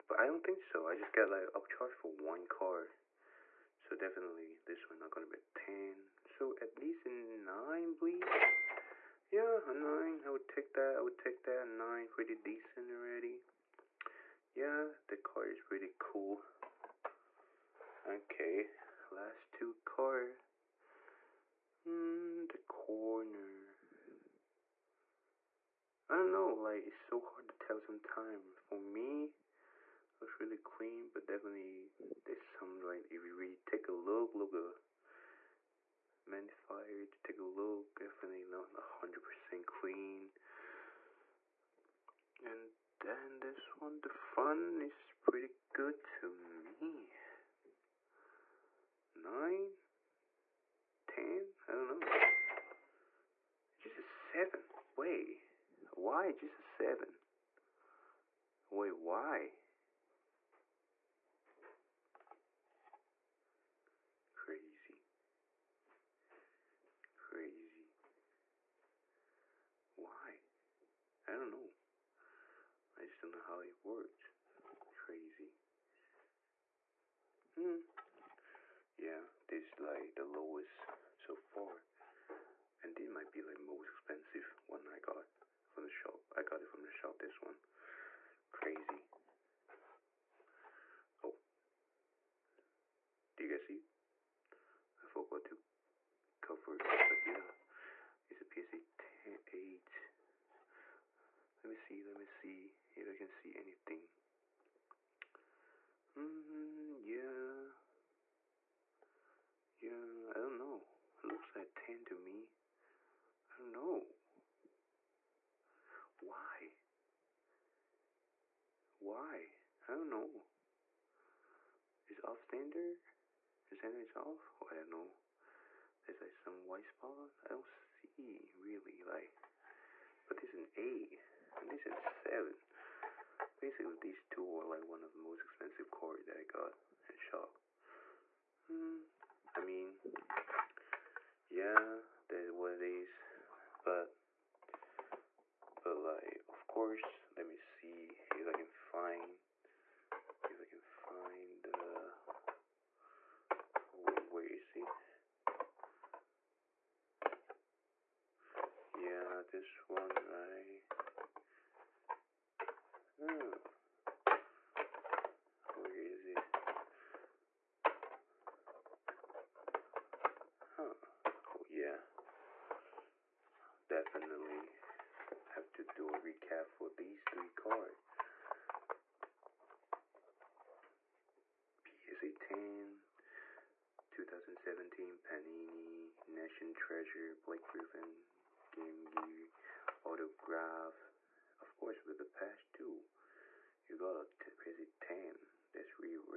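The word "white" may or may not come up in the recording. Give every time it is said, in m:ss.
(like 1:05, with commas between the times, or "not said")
2:06.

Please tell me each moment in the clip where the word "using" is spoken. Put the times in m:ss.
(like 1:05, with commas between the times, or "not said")
not said.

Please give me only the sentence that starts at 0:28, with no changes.
For me, looks really clean, but definitely there's some, right?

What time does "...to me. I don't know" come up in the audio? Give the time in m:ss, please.
1:52.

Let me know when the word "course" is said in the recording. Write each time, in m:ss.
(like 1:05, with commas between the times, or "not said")
2:26, 3:11.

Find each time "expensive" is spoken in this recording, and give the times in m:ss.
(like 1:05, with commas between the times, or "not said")
1:23, 2:15.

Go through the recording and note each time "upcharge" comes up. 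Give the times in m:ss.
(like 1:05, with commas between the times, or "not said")
0:01.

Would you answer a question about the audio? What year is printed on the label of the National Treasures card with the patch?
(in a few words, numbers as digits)
2017.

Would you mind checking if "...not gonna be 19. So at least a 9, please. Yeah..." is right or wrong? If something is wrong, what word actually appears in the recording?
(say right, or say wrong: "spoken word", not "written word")
wrong: "10", not "19".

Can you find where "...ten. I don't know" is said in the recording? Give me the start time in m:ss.
0:51.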